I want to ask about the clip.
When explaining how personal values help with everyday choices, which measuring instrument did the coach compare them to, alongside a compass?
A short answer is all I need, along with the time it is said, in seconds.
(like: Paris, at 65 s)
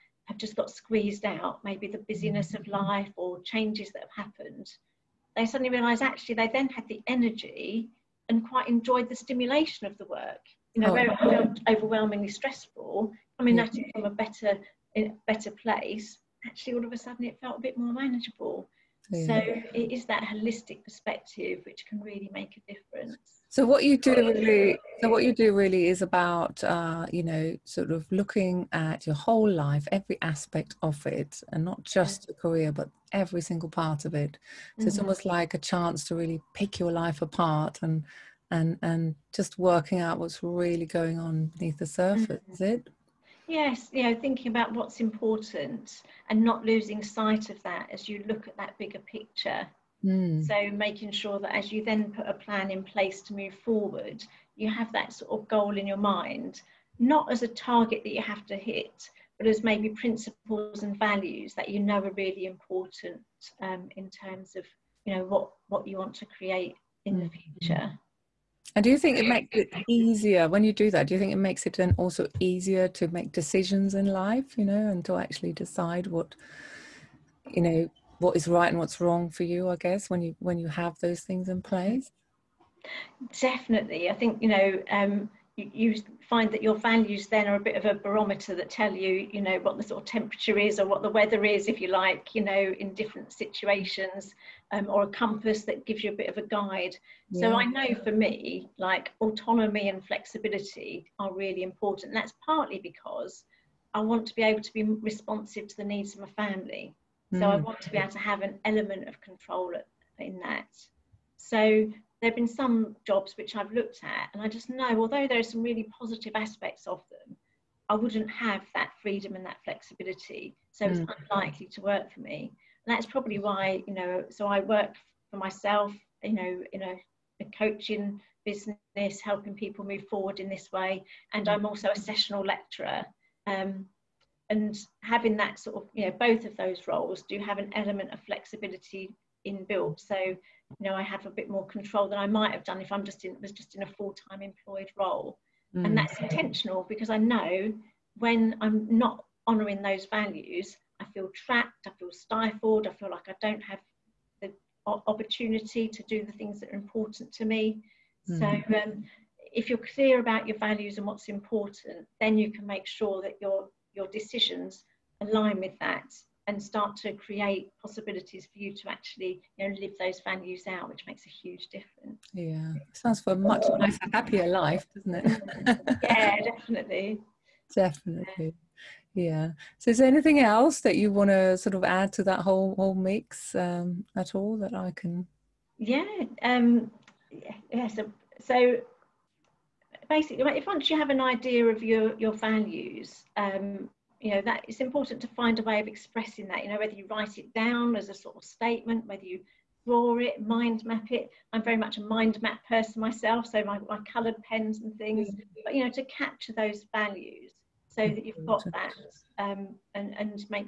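barometer, at 87 s.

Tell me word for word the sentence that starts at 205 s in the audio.
but you know to capture those values so that you've got mm-hmm.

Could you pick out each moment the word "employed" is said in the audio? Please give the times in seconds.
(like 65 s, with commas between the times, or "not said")
144 s.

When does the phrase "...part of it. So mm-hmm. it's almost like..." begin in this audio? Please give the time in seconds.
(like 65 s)
33 s.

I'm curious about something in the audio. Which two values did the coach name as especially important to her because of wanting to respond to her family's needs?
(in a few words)
autonomy and flexibility.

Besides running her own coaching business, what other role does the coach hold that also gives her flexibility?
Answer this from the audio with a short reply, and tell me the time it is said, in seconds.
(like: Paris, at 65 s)
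sessional lecturer, at 131 s.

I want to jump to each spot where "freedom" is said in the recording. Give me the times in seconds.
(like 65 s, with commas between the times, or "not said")
119 s.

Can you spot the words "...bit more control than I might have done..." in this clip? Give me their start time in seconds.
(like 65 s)
141 s.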